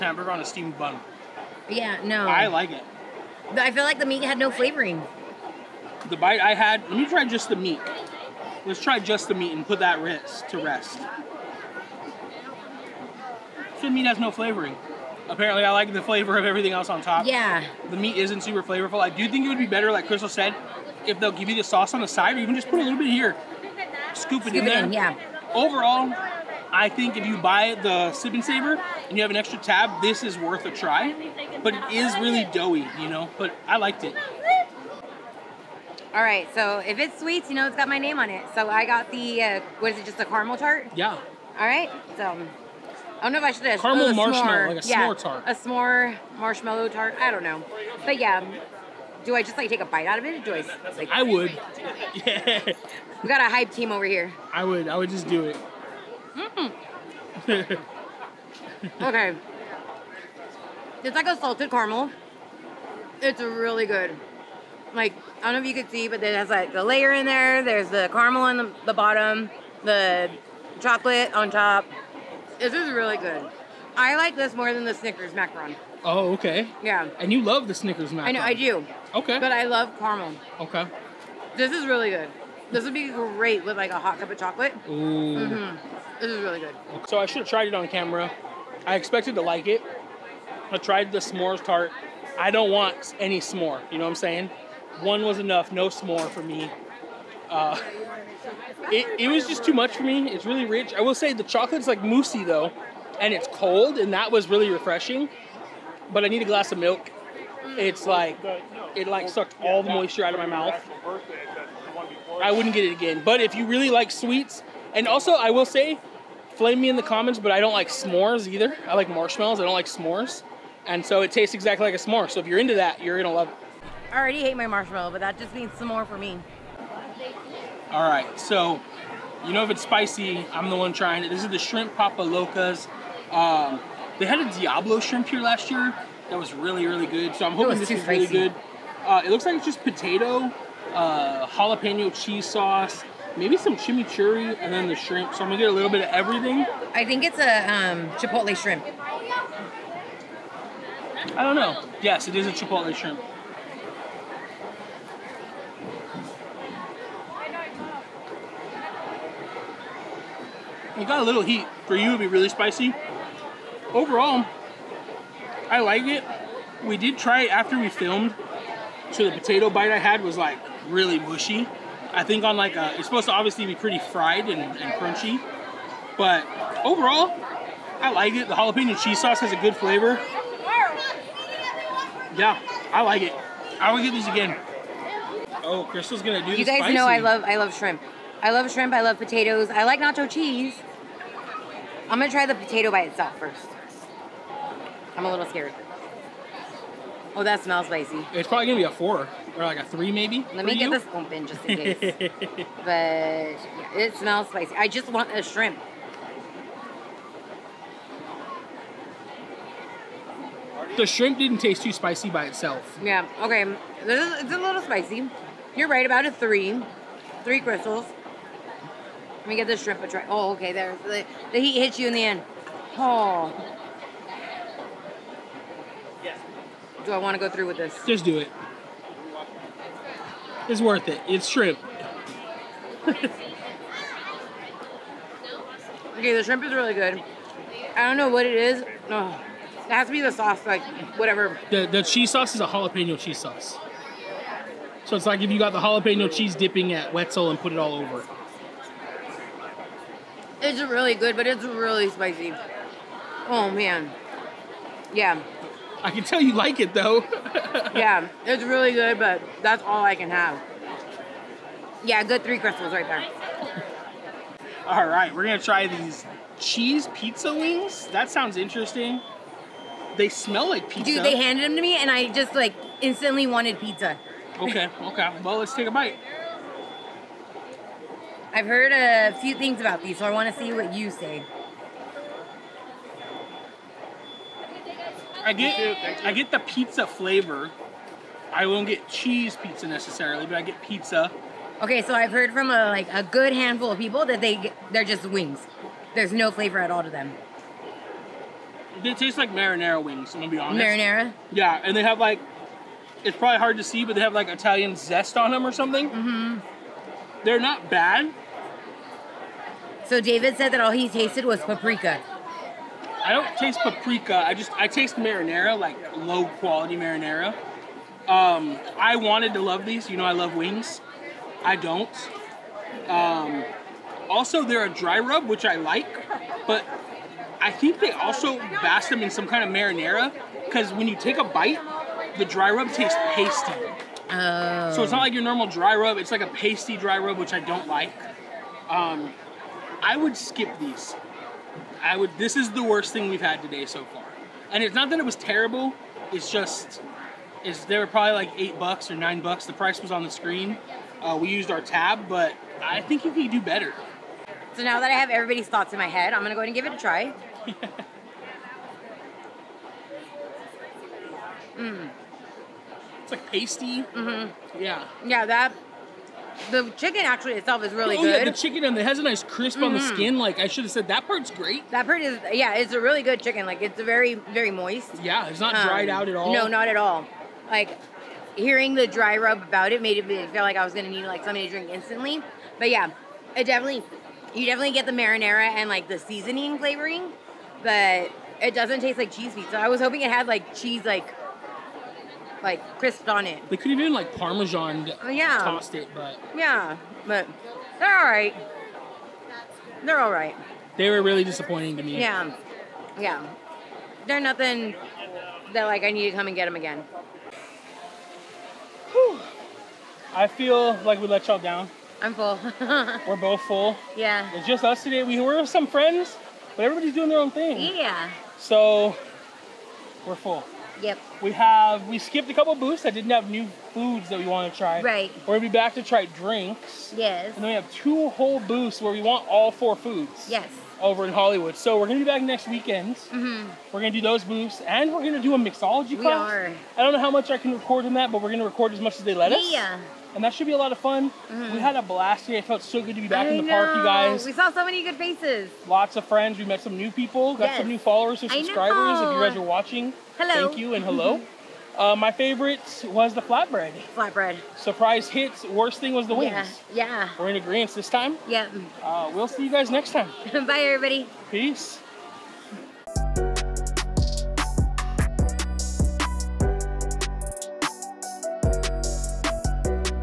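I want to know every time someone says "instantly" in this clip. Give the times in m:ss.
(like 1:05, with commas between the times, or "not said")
4:32, 6:21.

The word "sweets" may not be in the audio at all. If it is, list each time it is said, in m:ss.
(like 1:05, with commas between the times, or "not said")
0:37, 1:54.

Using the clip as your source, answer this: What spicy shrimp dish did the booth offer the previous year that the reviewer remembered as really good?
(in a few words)
Diablo shrimp.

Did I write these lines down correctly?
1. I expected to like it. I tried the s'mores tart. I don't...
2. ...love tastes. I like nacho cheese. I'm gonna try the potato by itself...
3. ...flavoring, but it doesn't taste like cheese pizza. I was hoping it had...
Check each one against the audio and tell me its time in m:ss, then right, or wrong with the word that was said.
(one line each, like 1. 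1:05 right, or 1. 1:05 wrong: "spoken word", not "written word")
1. 1:28 right
2. 3:09 wrong: "potatoes", not "tastes"
3. 6:26 right.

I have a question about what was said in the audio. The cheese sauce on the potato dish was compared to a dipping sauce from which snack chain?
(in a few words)
Wetzel.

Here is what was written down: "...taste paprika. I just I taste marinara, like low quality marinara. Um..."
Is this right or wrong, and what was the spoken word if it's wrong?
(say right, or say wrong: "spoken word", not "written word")
right.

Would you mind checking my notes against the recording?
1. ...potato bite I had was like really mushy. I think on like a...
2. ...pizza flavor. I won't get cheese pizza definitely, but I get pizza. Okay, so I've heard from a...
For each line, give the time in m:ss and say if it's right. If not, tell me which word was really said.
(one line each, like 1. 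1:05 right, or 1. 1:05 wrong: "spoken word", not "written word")
1. 2:49 right
2. 4:46 wrong: "necessarily", not "definitely".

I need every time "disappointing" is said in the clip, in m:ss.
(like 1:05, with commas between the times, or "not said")
6:41.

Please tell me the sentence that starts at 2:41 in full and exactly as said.
For you, it'd be really spicy.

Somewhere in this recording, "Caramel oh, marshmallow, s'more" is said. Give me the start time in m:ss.
0:43.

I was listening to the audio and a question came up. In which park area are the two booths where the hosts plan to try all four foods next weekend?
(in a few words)
Hollywood.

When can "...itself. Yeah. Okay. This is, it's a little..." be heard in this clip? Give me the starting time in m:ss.
3:32.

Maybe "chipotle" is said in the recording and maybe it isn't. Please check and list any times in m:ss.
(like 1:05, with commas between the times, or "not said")
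2:28, 2:32.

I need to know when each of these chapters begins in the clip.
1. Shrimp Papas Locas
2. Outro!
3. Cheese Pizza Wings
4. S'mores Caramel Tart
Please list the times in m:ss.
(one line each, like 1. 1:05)
1. 2:07
2. 6:46
3. 4:23
4. 0:34.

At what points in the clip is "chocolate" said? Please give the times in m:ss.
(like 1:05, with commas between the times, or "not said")
1:10, 1:24, 1:41.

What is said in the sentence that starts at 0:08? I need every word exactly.
Let's try just the meat and put that wrist to rest.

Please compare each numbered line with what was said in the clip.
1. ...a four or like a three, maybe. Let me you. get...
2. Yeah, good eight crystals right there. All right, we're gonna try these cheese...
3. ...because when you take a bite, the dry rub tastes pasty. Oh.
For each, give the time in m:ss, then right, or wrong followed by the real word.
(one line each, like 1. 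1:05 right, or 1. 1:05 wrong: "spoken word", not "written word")
1. 3:18 right
2. 4:22 wrong: "three", not "eight"
3. 5:30 right.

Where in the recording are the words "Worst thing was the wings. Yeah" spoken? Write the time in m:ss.
7:35.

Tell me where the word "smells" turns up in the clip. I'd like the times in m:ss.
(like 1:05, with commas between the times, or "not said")
3:17, 3:24, 4:30.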